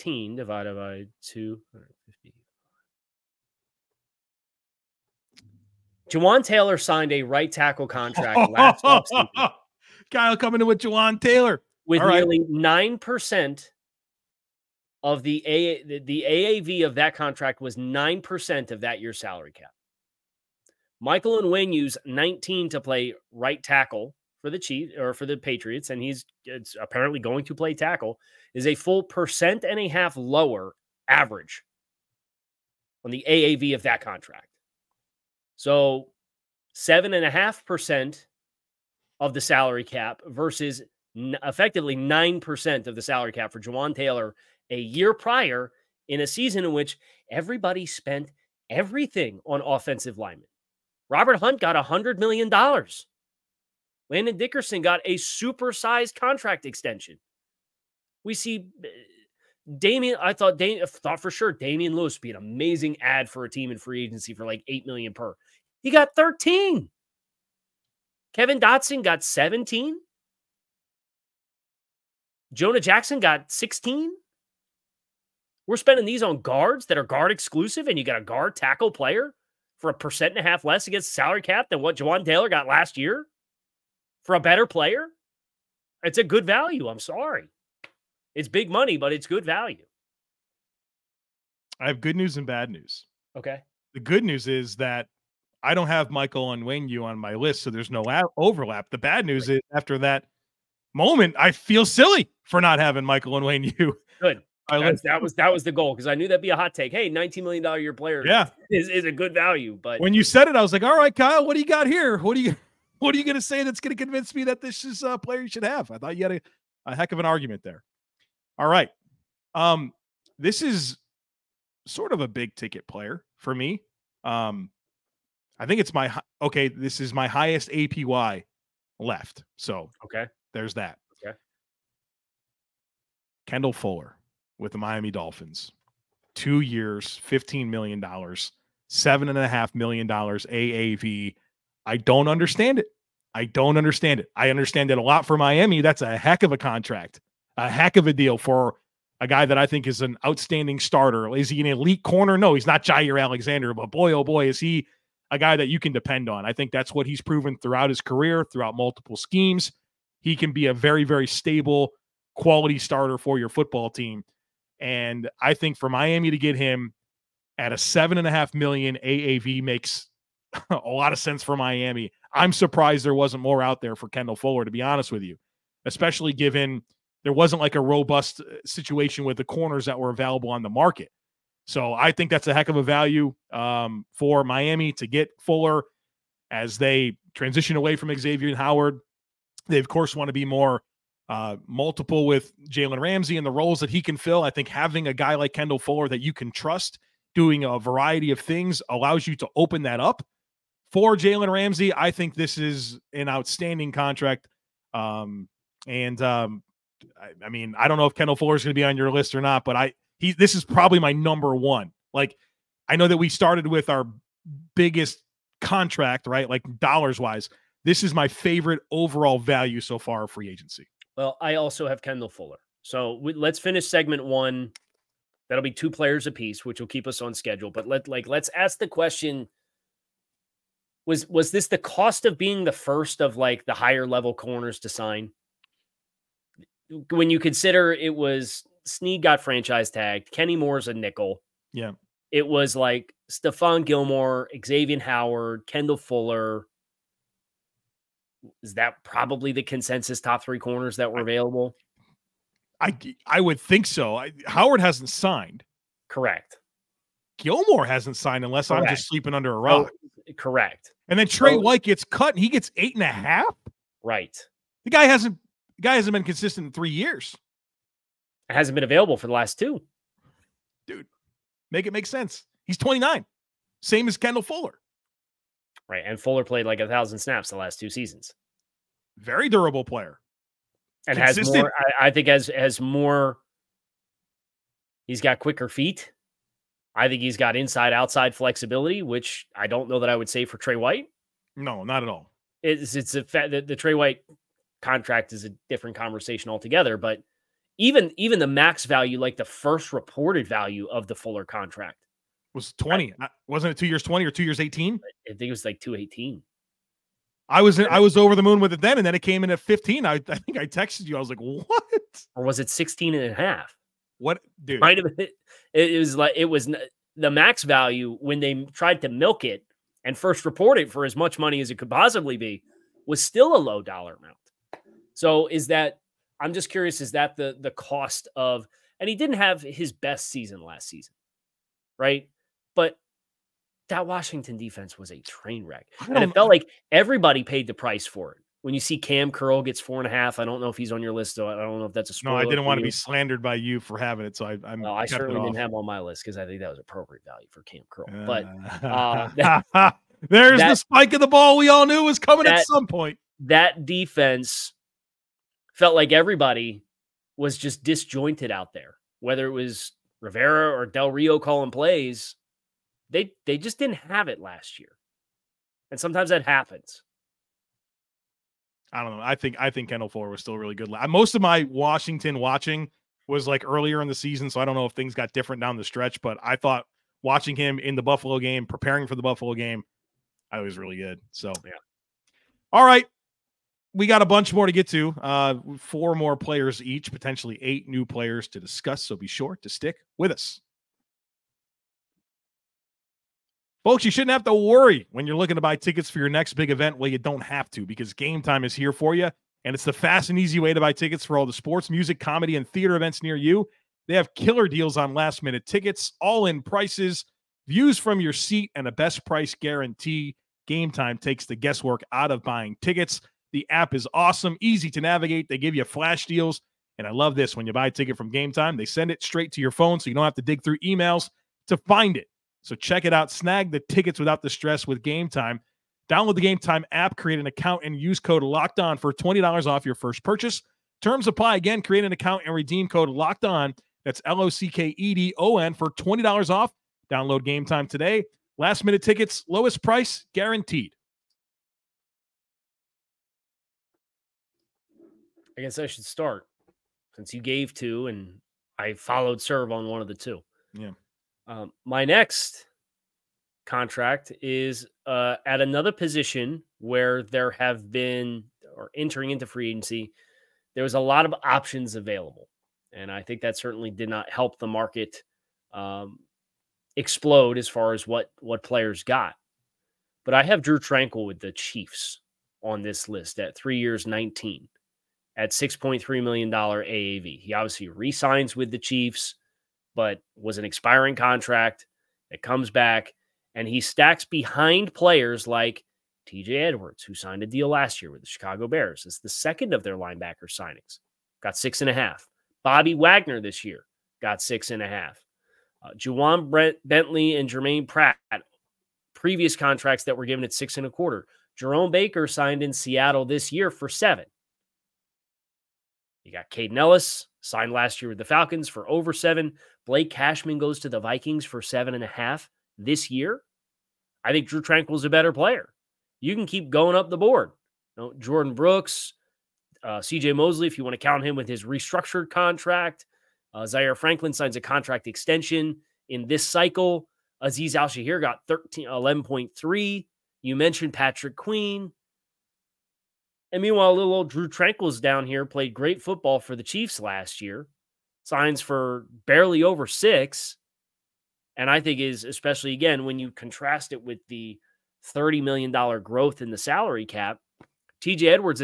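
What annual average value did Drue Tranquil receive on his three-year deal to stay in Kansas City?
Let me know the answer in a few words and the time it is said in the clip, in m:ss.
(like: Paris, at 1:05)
$6.3 million, at 7:55.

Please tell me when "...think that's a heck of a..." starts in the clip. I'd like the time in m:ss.
3:02.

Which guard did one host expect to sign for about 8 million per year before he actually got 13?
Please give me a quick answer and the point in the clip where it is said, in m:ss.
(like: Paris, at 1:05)
Damien Lewis, at 1:01.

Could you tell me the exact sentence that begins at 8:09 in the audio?
It's the second of their linebacker signings, got six and a half.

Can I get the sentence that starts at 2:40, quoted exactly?
He can be a very, very stable, quality starter for your football team.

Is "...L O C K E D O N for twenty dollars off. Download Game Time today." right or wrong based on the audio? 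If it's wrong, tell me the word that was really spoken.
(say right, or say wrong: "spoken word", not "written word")
right.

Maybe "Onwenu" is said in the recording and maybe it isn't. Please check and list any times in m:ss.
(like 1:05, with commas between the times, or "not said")
0:21, 1:36.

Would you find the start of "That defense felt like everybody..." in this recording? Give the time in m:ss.
5:53.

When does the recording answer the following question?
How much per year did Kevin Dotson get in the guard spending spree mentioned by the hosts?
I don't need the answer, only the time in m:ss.
1:08.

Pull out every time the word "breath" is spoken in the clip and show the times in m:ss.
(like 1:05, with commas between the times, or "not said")
not said.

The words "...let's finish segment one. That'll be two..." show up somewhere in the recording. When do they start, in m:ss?
3:43.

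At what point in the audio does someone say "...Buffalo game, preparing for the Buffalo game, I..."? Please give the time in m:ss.
6:18.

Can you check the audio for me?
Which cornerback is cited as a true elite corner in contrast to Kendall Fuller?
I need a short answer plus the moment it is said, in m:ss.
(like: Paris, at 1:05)
Jaire Alexander, at 2:32.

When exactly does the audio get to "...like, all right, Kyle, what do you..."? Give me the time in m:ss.
1:50.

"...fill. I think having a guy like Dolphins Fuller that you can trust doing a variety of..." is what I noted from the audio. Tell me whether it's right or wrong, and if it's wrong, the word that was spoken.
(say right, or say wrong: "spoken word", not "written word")
wrong: "Kendall", not "Dolphins".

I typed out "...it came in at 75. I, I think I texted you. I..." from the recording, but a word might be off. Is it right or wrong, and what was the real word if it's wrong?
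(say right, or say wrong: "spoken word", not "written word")
wrong: "15", not "75".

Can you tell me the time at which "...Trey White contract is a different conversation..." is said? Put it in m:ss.
4:53.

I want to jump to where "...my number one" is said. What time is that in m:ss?
3:30.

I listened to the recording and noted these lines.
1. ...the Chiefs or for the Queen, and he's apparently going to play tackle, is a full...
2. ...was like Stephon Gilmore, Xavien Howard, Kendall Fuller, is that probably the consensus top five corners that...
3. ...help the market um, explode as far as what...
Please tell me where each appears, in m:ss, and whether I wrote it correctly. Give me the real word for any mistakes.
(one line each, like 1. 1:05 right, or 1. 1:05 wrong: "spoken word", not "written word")
1. 0:24 wrong: "Patriots", not "Queen"
2. 4:02 wrong: "three", not "five"
3. 7:44 right.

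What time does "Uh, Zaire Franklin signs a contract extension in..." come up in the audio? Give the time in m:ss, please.
8:43.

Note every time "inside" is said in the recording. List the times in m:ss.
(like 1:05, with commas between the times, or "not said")
4:47.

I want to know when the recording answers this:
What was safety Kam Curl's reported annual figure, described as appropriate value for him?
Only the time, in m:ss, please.
5:39.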